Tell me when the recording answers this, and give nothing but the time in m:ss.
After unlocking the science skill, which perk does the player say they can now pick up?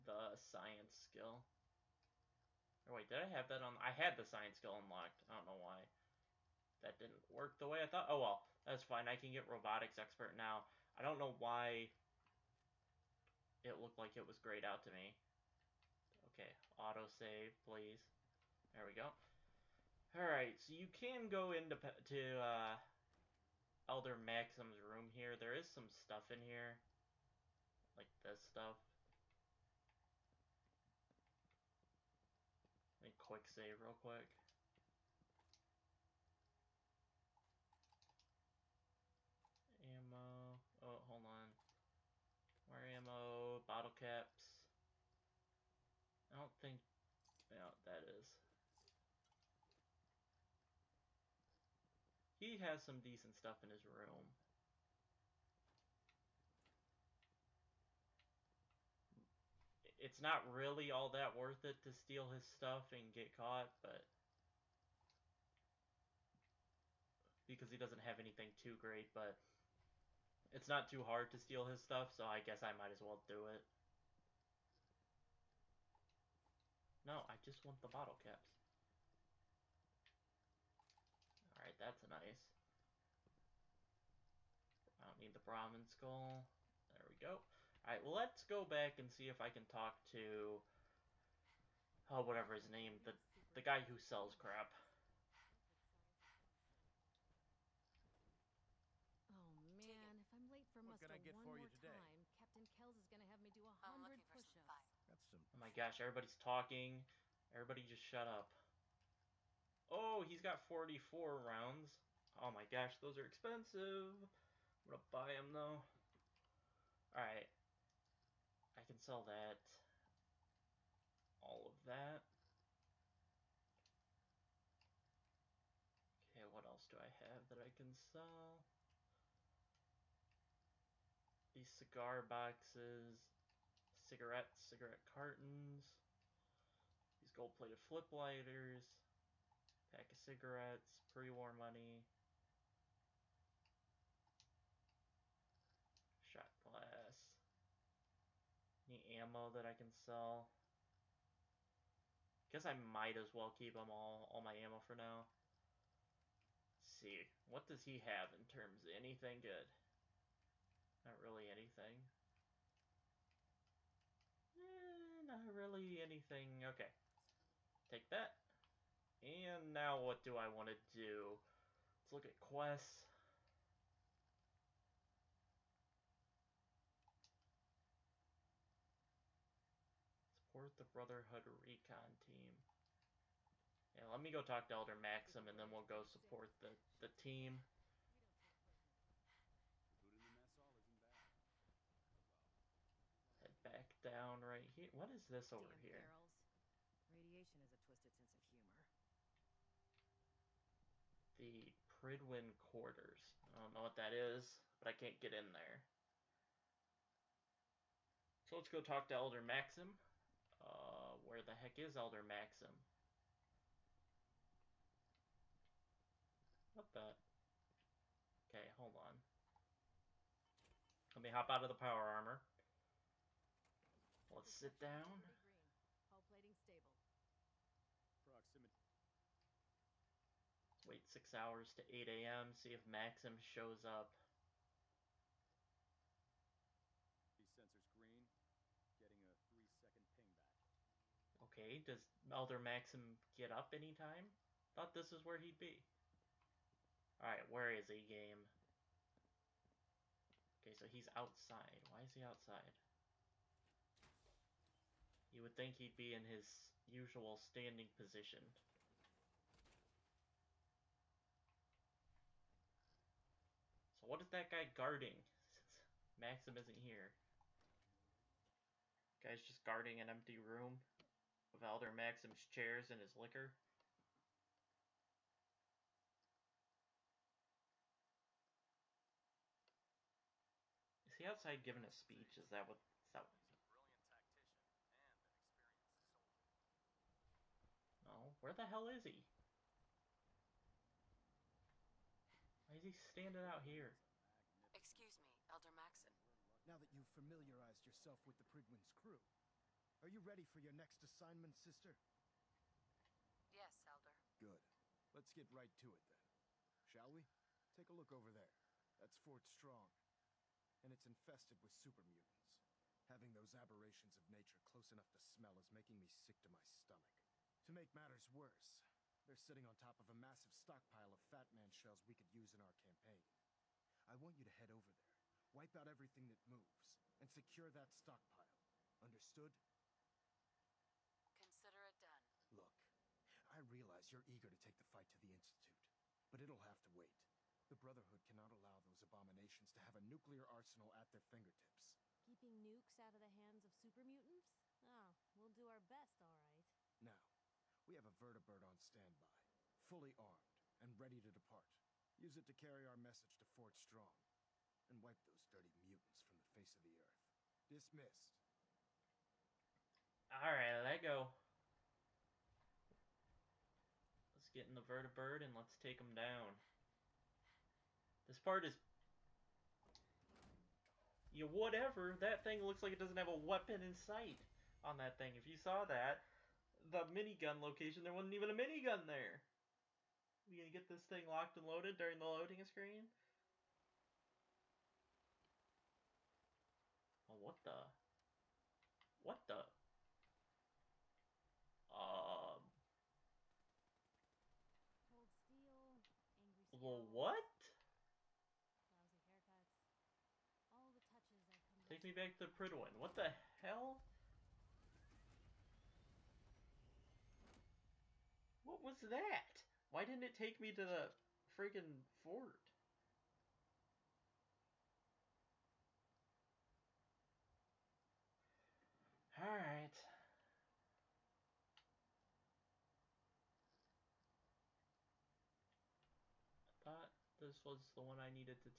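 0:09.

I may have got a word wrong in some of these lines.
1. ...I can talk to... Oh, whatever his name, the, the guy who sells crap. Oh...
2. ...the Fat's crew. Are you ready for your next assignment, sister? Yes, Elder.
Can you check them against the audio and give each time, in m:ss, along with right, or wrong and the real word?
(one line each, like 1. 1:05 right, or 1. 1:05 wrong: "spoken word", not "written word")
1. 1:29 right
2. 4:58 wrong: "Prydwen", not "Fat".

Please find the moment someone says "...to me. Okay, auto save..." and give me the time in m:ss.
0:14.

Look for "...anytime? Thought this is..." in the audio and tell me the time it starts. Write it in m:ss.
4:03.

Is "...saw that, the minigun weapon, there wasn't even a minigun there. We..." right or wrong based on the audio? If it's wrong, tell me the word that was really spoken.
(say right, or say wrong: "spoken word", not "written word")
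wrong: "location", not "weapon".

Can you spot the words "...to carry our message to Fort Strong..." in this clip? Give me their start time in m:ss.
5:52.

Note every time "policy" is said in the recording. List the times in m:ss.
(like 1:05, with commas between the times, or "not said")
not said.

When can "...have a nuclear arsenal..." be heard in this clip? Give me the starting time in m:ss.
5:39.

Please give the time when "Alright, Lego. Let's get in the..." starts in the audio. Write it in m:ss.
6:00.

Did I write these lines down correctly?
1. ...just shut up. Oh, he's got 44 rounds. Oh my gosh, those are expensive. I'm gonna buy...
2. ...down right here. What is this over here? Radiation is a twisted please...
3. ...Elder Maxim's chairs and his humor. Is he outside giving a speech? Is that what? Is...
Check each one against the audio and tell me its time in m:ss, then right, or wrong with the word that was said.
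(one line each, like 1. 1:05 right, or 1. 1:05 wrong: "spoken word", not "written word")
1. 1:47 right
2. 3:14 wrong: "sense", not "please"
3. 4:31 wrong: "liquor", not "humor".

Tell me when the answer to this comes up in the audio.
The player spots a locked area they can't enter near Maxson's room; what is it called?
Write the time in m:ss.
3:21.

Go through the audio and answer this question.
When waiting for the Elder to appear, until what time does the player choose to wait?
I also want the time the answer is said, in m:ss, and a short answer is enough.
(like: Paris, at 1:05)
8 a.m., at 3:51.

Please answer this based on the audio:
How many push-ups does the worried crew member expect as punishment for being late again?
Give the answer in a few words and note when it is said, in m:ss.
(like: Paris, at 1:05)
100, at 1:43.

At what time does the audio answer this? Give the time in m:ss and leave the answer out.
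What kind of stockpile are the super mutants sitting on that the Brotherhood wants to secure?
5:21.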